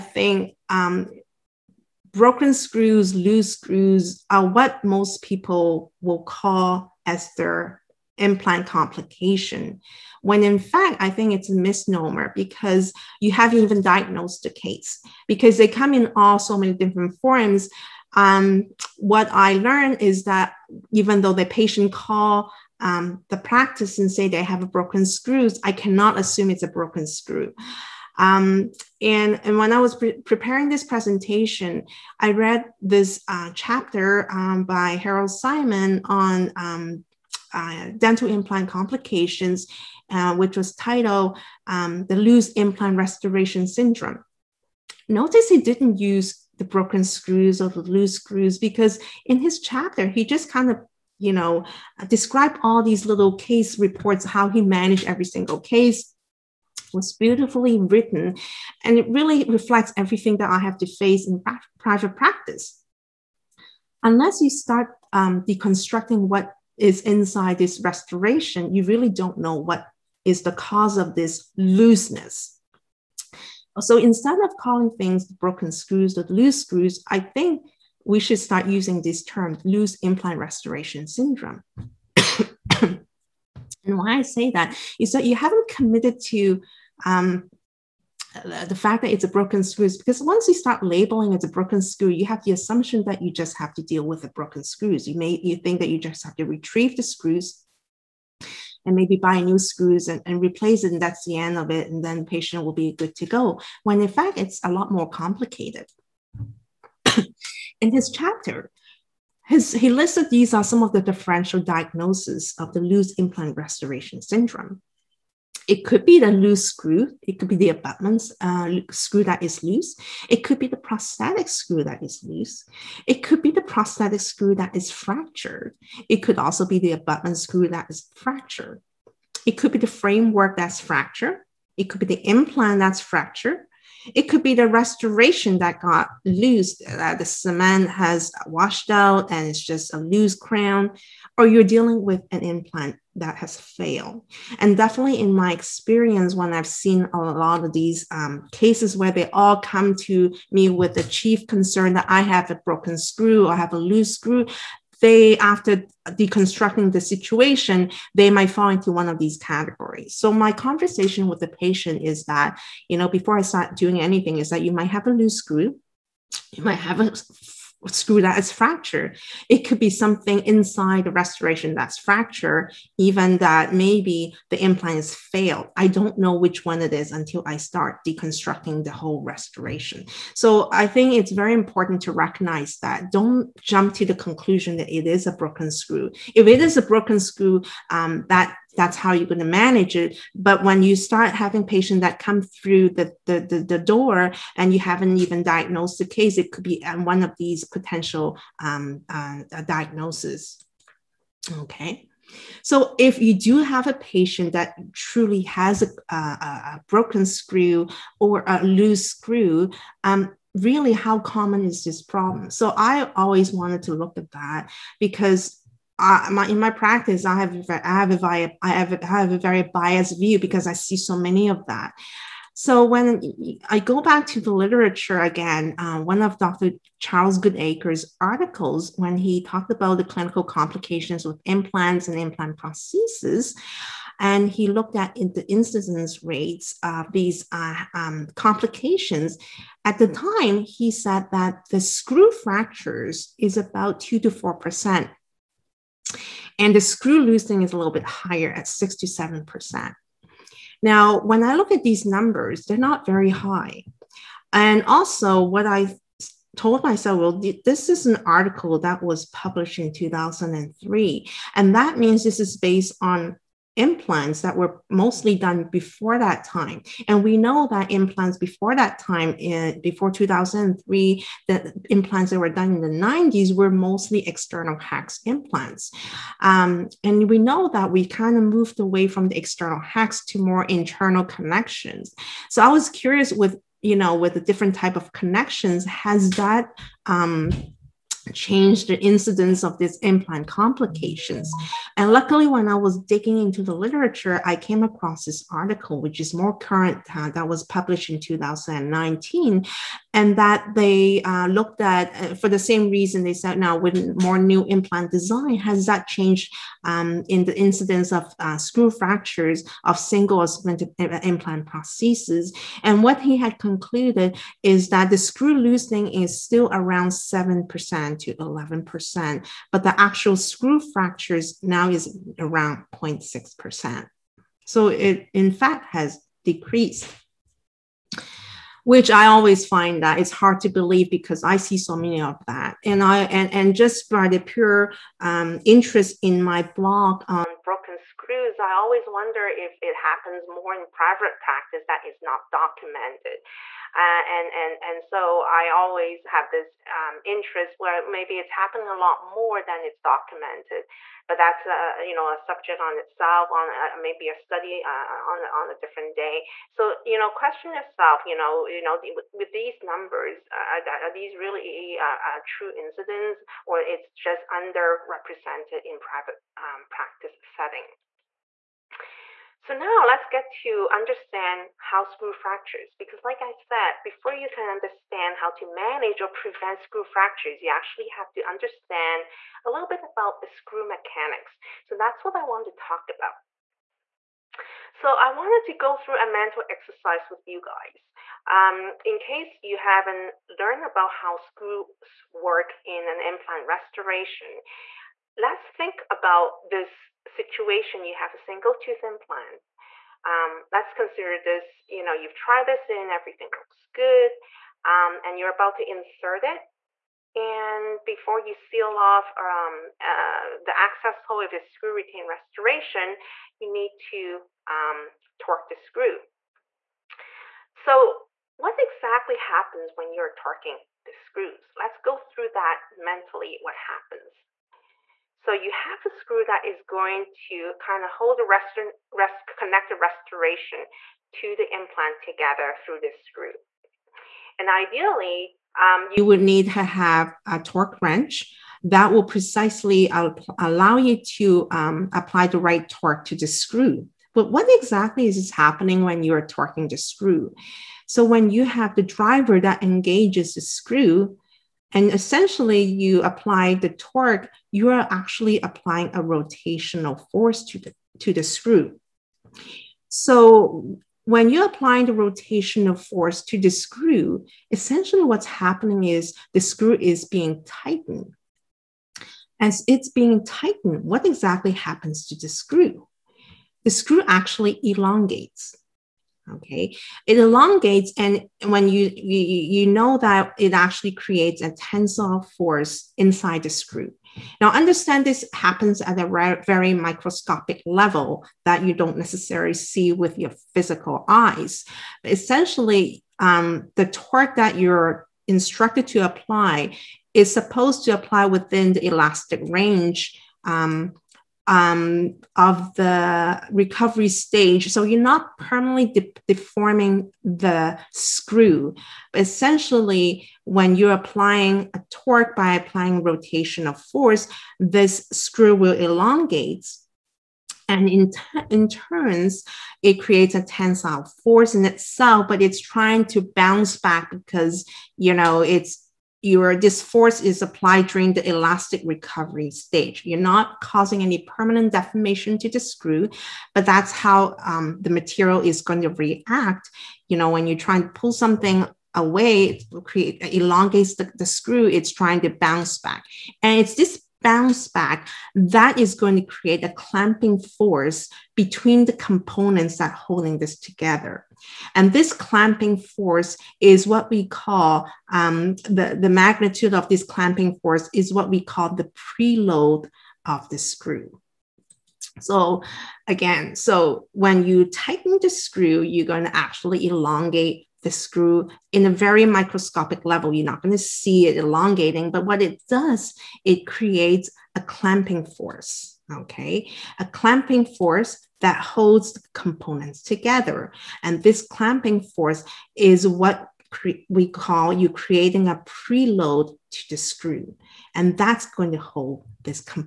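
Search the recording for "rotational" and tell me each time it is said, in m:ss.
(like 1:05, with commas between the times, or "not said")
7:36, 7:42, 8:33.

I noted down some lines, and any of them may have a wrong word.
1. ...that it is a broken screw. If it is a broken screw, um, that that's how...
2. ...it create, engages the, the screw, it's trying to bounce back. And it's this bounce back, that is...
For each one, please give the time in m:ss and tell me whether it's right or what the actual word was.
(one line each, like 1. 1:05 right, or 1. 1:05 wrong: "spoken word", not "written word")
1. 3:04 right
2. 8:59 wrong: "elongates", not "engages".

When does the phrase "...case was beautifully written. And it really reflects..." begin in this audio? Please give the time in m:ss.
0:55.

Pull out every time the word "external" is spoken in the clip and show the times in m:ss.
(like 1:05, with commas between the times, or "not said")
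4:34, 4:39.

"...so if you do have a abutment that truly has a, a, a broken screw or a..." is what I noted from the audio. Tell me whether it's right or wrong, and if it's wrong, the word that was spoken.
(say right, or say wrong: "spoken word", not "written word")
wrong: "patient", not "abutment".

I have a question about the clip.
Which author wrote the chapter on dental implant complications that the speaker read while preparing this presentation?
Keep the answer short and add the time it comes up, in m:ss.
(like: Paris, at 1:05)
Harel Simon, at 0:34.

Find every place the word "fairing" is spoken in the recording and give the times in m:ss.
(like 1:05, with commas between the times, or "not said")
not said.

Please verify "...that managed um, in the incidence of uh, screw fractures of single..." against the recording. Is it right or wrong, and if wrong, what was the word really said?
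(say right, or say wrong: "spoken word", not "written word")
wrong: "changed", not "managed".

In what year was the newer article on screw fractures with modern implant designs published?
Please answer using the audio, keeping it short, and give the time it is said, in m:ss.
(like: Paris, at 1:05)
2019, at 4:58.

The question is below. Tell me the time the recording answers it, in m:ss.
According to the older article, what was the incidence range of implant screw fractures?
4:04.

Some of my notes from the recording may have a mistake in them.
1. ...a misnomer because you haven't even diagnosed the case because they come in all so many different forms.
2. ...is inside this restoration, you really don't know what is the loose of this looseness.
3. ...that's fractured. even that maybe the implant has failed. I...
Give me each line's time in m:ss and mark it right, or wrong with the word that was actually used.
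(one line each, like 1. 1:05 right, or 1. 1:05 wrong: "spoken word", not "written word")
1. 0:11 right
2. 1:06 wrong: "cause", not "loose"
3. 2:51 right.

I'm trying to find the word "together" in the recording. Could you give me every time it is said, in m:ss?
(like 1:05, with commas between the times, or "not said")
7:12, 9:10, 9:40.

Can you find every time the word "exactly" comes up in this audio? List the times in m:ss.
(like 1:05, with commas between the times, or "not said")
6:58, 7:24, 7:51.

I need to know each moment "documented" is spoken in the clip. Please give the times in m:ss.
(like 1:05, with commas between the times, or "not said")
5:42, 5:50.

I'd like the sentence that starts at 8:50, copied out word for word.
You're not causing any permanent deformation to the screw, but that's how um, the material is going to react.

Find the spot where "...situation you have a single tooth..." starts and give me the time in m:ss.
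6:37.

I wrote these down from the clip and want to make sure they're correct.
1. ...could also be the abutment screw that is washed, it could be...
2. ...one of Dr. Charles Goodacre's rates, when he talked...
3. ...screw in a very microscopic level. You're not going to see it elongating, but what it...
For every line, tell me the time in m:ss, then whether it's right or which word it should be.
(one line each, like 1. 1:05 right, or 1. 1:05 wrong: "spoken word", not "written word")
1. 2:06 wrong: "fractured", not "washed"
2. 3:46 wrong: "articles", not "rates"
3. 9:28 right.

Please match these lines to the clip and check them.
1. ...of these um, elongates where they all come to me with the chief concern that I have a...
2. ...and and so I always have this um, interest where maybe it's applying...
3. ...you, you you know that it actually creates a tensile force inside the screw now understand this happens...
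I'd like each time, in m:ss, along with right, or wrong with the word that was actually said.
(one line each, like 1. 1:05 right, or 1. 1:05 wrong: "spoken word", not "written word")
1. 2:27 wrong: "cases", not "elongates"
2. 5:44 wrong: "happening", not "applying"
3. 7:58 right.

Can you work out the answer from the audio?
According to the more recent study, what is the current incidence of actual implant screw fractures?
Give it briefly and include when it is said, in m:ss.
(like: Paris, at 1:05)
0.6%, at 5:22.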